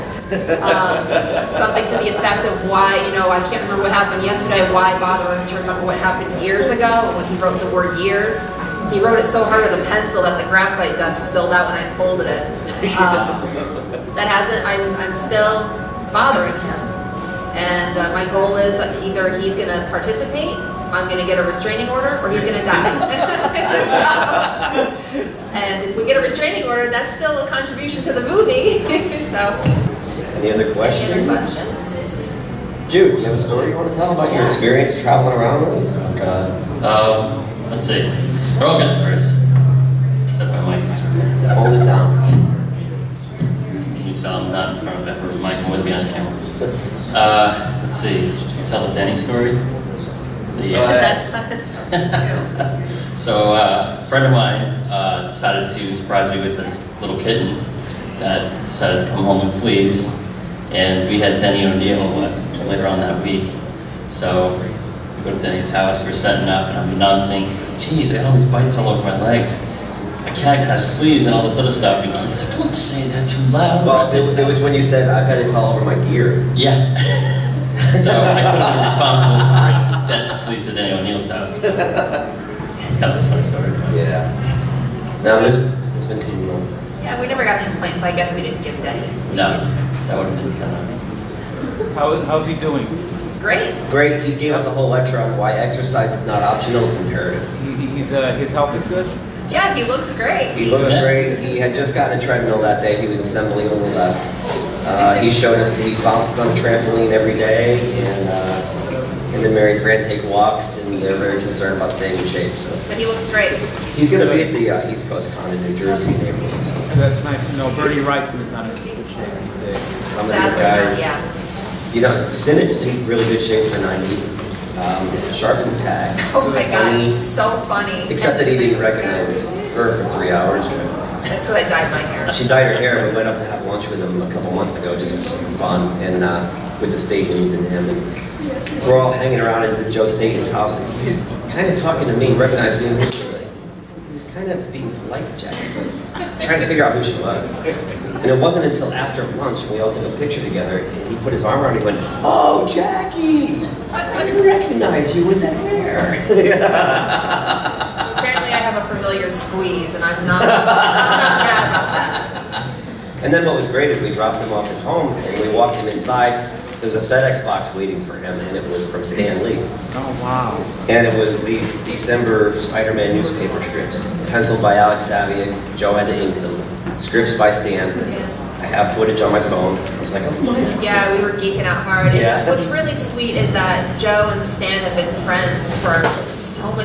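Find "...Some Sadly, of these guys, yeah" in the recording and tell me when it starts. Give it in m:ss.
1:59.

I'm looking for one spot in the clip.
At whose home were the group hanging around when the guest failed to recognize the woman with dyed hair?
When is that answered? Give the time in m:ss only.
2:19.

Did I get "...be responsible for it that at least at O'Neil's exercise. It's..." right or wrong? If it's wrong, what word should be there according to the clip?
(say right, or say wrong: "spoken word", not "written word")
wrong: "house", not "exercise".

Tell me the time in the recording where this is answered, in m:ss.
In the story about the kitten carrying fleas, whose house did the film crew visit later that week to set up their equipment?
1:01.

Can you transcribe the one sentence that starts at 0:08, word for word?
He wrote it so hard with a pencil that the graphite dust spilled out when I folded it.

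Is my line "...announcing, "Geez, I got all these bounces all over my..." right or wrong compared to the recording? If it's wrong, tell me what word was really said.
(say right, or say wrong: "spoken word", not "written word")
wrong: "bites", not "bounces".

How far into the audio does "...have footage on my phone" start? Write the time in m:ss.
2:58.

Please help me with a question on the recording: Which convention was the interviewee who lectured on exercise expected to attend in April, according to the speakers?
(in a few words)
East Coast Con.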